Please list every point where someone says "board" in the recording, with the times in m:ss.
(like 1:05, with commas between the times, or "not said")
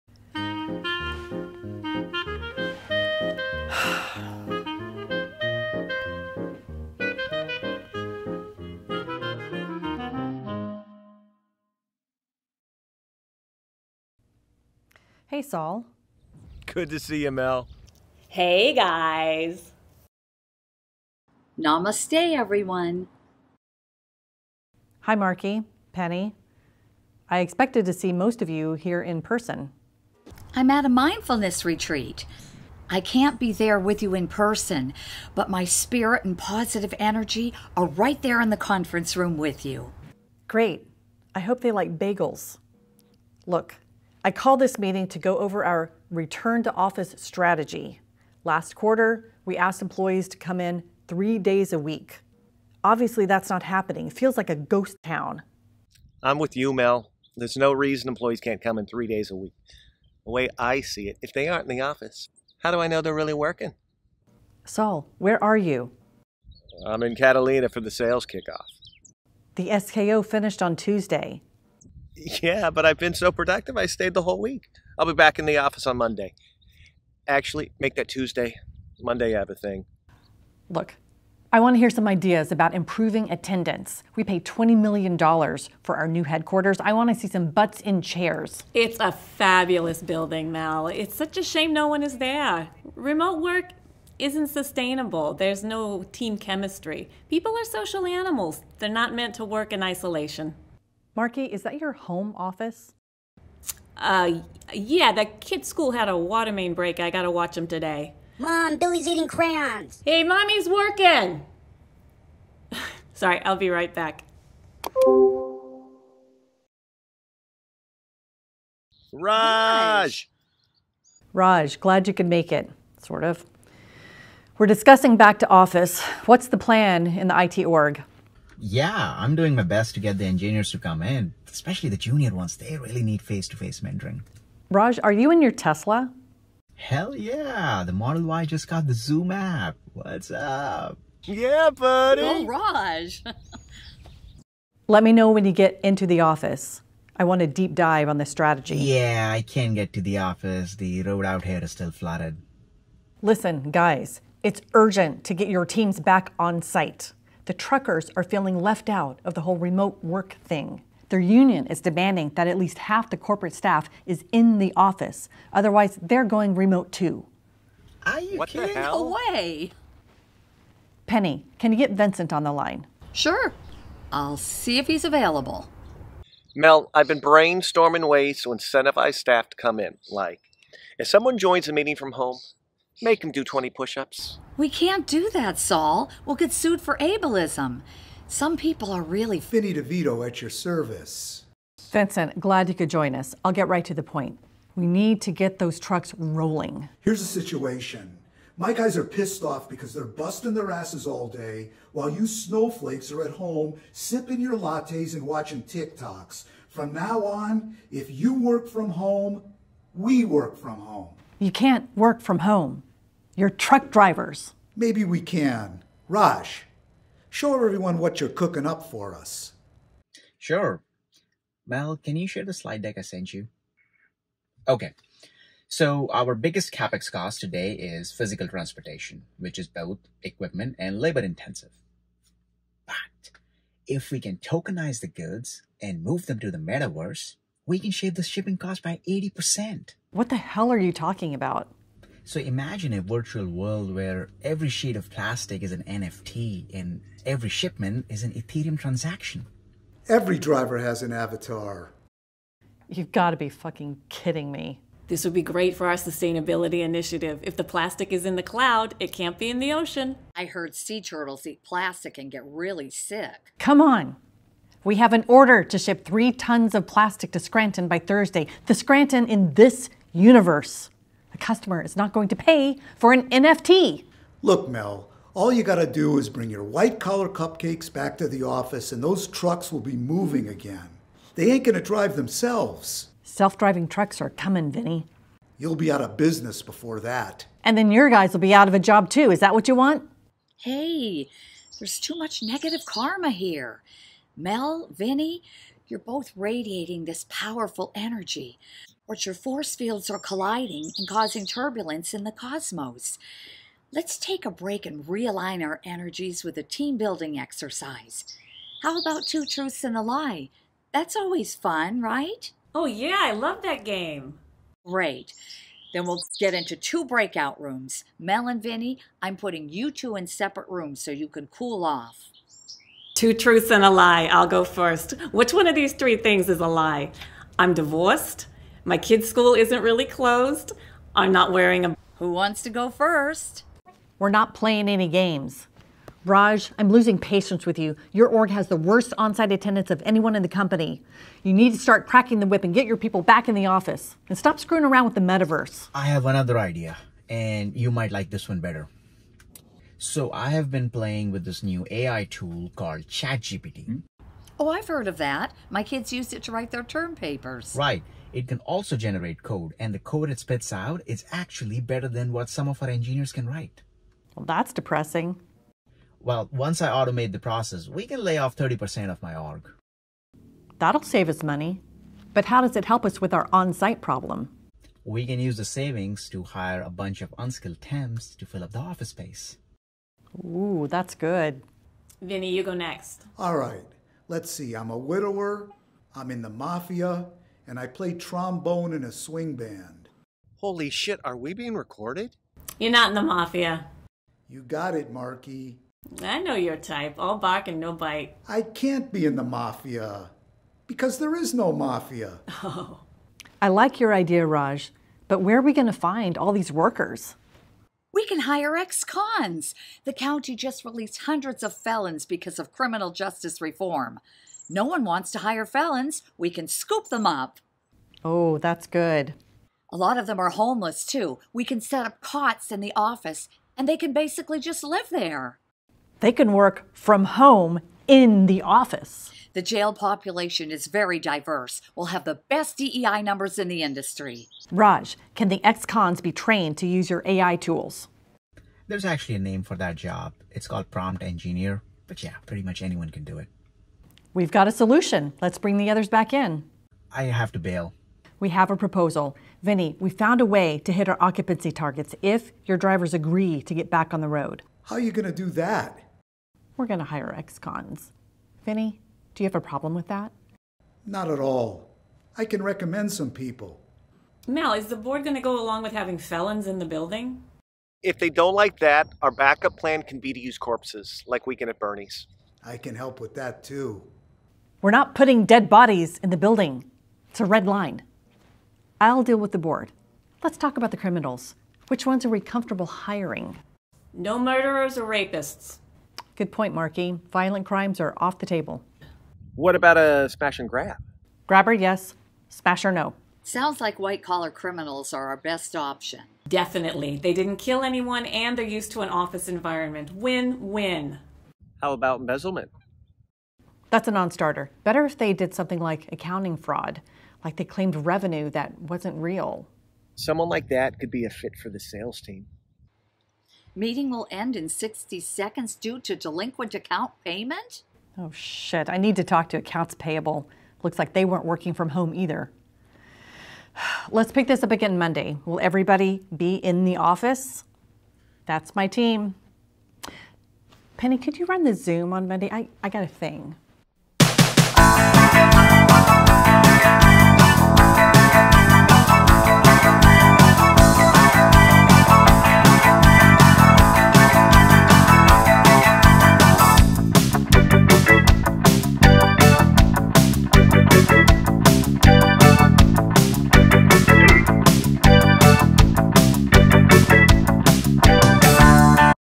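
7:44, 7:59.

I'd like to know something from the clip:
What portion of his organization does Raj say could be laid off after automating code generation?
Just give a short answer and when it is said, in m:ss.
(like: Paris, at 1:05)
30%, at 6:08.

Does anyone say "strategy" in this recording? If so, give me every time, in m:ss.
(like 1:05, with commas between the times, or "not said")
0:47, 2:28.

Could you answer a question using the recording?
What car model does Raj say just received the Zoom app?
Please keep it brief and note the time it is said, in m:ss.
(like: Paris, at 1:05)
Model Y, at 2:17.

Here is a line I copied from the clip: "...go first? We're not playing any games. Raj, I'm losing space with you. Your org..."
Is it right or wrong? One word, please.
wrong.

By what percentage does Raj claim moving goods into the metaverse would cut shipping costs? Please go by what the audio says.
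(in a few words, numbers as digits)
80%.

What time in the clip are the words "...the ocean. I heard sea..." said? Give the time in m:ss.
4:19.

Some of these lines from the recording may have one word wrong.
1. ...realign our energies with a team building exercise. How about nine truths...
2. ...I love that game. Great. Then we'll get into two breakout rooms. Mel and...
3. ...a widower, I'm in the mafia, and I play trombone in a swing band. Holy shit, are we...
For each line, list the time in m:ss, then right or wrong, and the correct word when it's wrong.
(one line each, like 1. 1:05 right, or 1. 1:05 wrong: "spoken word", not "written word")
1. 5:05 wrong: "two", not "nine"
2. 5:13 right
3. 6:24 right.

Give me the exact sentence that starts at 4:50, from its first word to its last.
Hey, there's too much negative karma here.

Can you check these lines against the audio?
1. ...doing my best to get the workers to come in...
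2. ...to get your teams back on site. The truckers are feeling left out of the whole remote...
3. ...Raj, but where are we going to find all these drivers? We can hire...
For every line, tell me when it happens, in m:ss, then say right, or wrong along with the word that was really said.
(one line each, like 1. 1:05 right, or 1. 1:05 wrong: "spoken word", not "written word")
1. 2:09 wrong: "engineers", not "workers"
2. 2:35 right
3. 6:44 wrong: "workers", not "drivers".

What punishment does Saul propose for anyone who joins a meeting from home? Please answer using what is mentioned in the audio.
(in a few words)
20 push ups.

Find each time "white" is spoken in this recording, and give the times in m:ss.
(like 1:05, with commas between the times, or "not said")
4:36, 8:13.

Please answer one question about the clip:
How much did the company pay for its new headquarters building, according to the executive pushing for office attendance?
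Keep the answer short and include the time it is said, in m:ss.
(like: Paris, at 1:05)
$20 million, at 1:24.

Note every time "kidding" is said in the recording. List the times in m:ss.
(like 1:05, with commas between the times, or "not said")
2:48, 4:14.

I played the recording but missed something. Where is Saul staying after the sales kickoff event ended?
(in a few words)
Catalina.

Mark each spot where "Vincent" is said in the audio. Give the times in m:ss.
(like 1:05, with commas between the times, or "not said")
2:51, 3:11.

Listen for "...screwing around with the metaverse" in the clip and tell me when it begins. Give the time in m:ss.
5:44.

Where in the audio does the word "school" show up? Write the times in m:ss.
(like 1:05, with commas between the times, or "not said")
1:45, 5:29.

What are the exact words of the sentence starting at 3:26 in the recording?
From now on, if you work from home, we work from home.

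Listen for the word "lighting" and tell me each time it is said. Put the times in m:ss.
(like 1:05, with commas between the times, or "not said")
not said.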